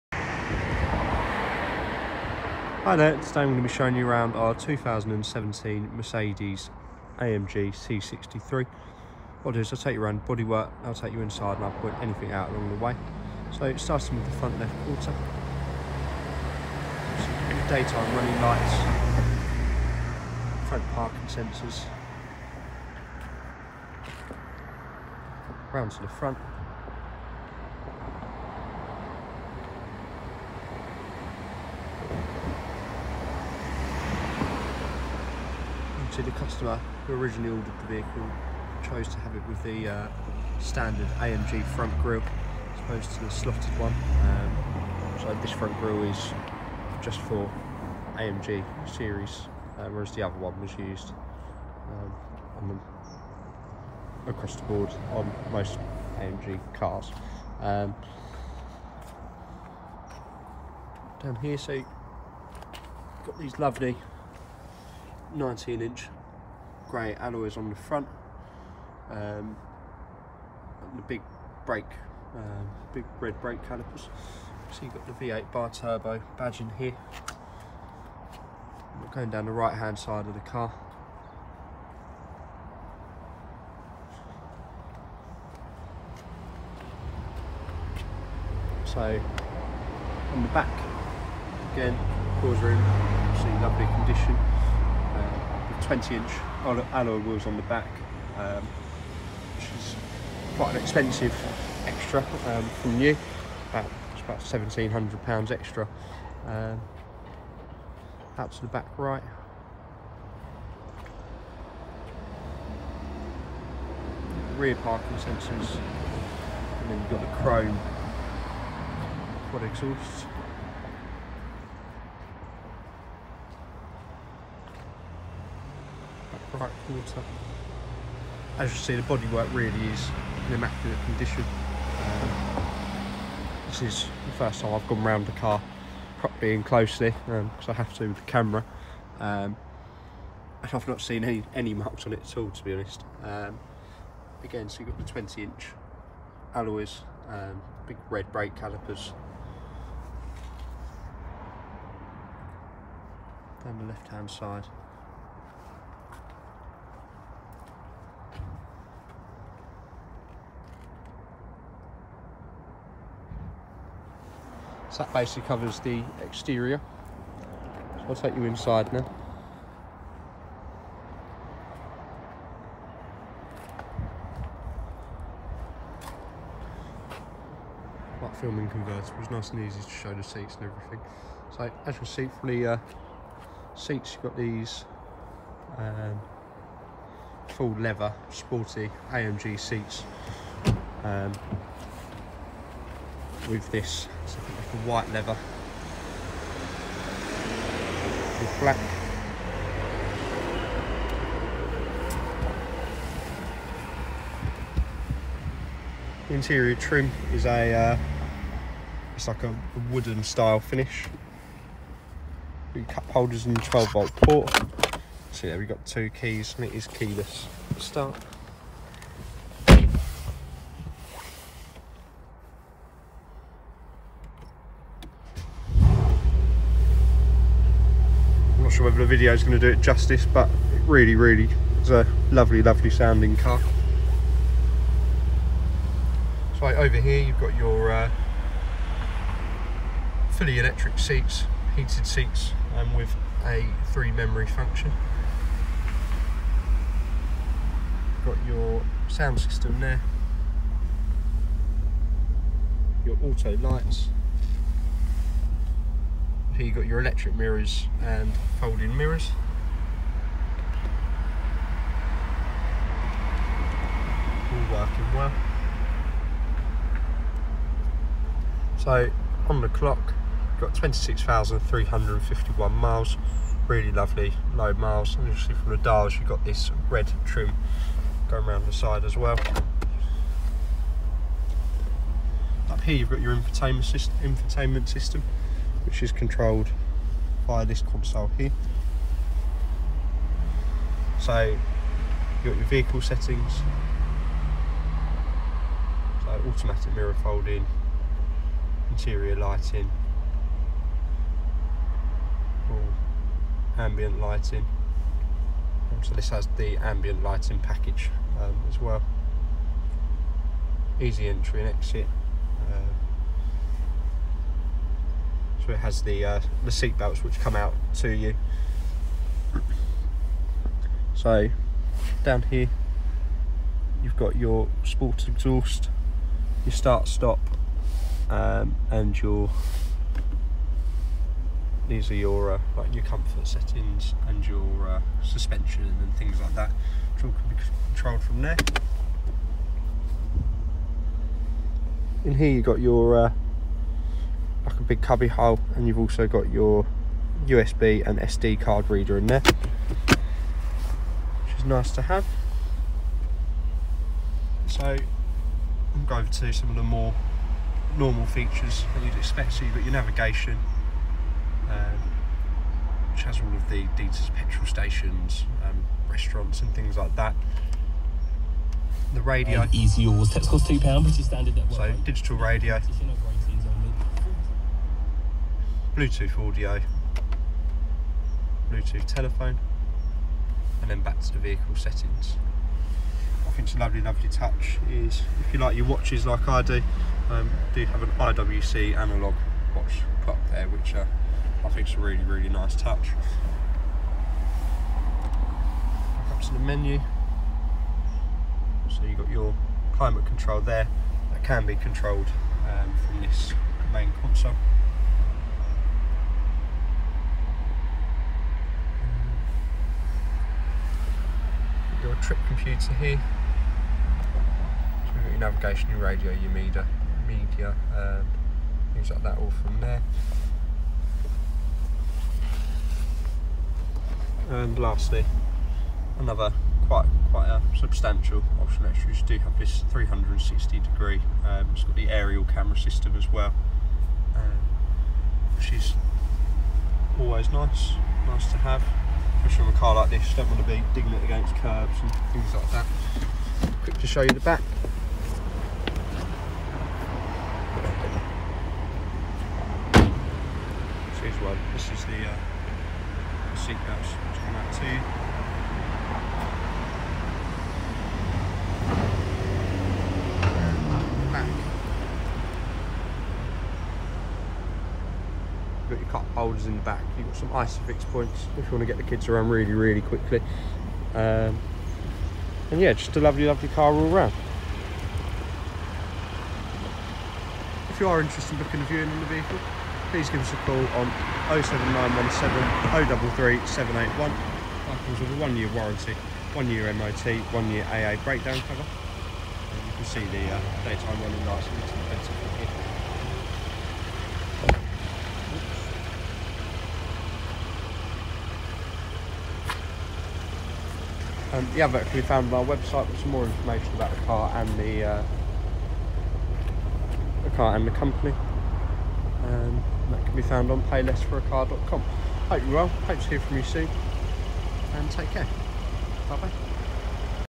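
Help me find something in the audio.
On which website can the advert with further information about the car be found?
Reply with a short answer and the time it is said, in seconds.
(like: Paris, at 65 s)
payless4acar.com, at 510 s.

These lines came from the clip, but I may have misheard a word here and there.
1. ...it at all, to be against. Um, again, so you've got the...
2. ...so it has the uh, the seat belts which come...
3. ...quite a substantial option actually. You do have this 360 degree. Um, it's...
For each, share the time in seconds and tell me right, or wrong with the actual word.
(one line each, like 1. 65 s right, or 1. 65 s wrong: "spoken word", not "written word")
1. 142 s wrong: "honest", not "against"
2. 315 s right
3. 427 s right.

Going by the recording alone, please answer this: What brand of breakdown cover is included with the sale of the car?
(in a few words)
AA.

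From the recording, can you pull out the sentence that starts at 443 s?
Quick to show you the back.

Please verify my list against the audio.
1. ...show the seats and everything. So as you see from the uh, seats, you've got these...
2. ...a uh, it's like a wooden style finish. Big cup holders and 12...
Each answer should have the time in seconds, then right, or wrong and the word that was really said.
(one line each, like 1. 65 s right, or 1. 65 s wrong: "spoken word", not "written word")
1. 179 s right
2. 207 s right.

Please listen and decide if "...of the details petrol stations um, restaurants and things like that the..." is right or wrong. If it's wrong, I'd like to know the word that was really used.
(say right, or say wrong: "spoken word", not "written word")
right.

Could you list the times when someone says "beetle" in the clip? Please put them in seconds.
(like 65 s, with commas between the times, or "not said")
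not said.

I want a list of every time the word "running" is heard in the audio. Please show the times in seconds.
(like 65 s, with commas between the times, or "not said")
18 s, 491 s.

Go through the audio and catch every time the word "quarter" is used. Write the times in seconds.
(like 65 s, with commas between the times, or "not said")
14 s, 126 s.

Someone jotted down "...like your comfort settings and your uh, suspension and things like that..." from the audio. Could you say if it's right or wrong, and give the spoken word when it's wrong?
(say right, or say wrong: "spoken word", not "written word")
right.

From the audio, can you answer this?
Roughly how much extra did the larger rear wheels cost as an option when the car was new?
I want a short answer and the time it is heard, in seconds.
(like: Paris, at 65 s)
1700 pounds, at 104 s.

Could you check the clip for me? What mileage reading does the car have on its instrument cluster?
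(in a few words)
26,351 miles.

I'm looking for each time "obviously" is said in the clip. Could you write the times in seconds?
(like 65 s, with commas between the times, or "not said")
36 s, 275 s.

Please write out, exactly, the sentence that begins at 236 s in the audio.
So right, over here you've got your uh, fully electric seats, heated seats um, with a three memory function.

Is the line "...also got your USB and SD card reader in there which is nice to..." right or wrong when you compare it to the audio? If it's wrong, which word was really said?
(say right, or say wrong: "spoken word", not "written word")
right.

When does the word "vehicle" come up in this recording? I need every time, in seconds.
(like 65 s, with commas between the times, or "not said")
37 s, 292 s, 381 s, 479 s.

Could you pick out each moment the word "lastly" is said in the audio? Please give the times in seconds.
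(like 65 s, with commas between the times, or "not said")
424 s.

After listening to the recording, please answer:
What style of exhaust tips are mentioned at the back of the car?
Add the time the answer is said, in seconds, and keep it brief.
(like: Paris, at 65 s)
chrome quad exhausts, at 117 s.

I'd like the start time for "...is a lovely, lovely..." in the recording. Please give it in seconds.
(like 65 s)
231 s.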